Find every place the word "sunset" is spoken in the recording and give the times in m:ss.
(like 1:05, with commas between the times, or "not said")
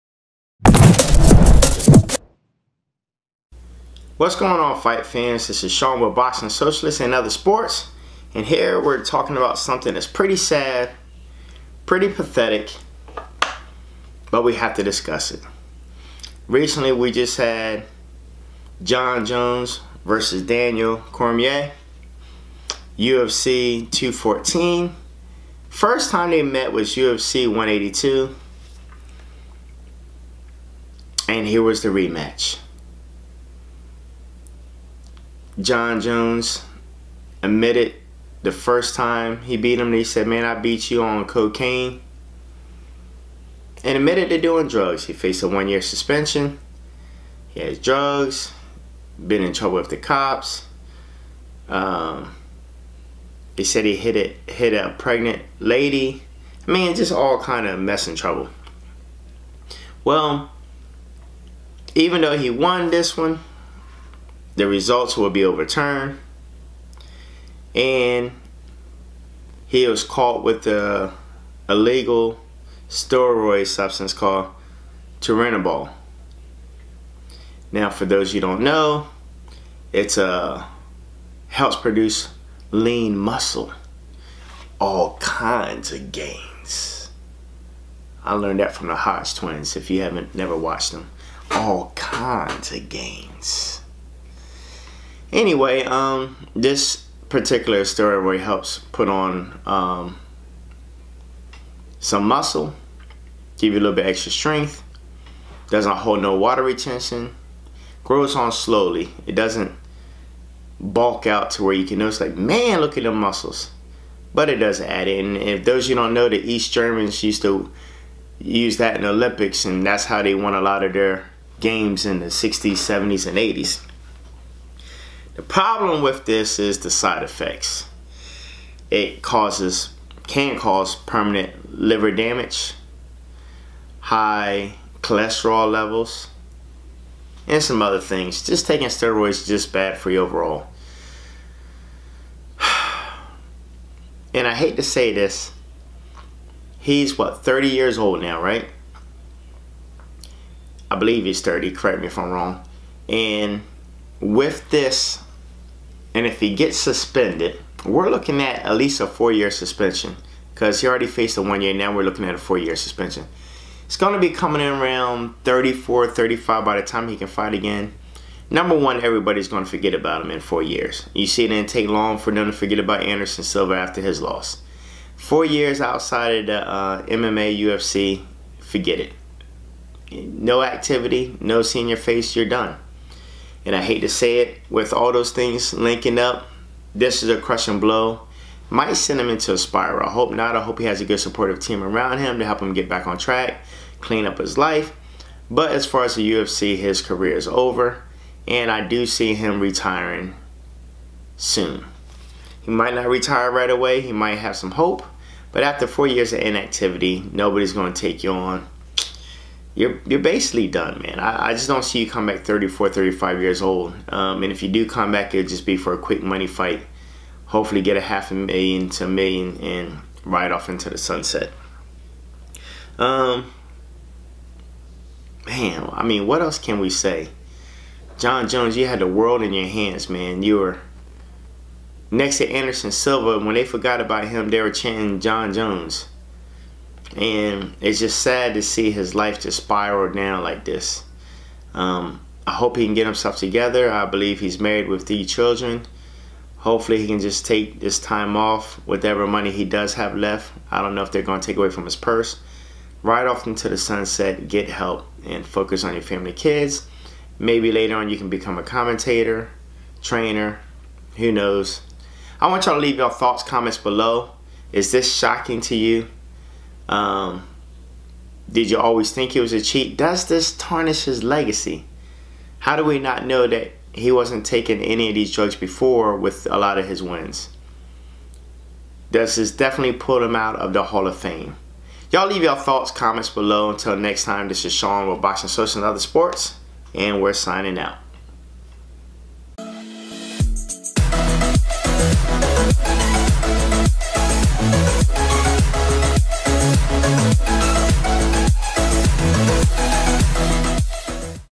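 3:40, 4:13.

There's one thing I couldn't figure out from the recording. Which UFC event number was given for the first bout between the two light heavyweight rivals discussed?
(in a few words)
UFC 182.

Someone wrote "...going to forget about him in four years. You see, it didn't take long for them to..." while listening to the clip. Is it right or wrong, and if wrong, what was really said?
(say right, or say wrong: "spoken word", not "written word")
right.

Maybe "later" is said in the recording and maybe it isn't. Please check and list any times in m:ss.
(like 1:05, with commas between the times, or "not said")
4:17.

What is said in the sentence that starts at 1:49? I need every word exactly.
It doesn't bulk out to where you can notice like, man, look at the muscles.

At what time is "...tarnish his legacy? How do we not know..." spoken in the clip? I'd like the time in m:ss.
4:30.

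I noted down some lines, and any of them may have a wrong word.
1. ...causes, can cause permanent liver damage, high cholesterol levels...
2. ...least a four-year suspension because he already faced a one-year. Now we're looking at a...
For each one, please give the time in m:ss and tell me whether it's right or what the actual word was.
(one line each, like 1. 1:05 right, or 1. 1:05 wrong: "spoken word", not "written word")
1. 2:09 right
2. 2:38 right.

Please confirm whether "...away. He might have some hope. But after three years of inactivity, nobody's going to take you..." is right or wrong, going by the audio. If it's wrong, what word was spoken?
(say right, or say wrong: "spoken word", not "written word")
wrong: "four", not "three".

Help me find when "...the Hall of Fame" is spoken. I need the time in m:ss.
4:40.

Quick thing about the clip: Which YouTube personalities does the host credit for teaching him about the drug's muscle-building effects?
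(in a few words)
the Hodge twins.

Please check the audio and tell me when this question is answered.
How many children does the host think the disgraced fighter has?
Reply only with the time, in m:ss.
4:05.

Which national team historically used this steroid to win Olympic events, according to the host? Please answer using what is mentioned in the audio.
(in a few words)
East Germans.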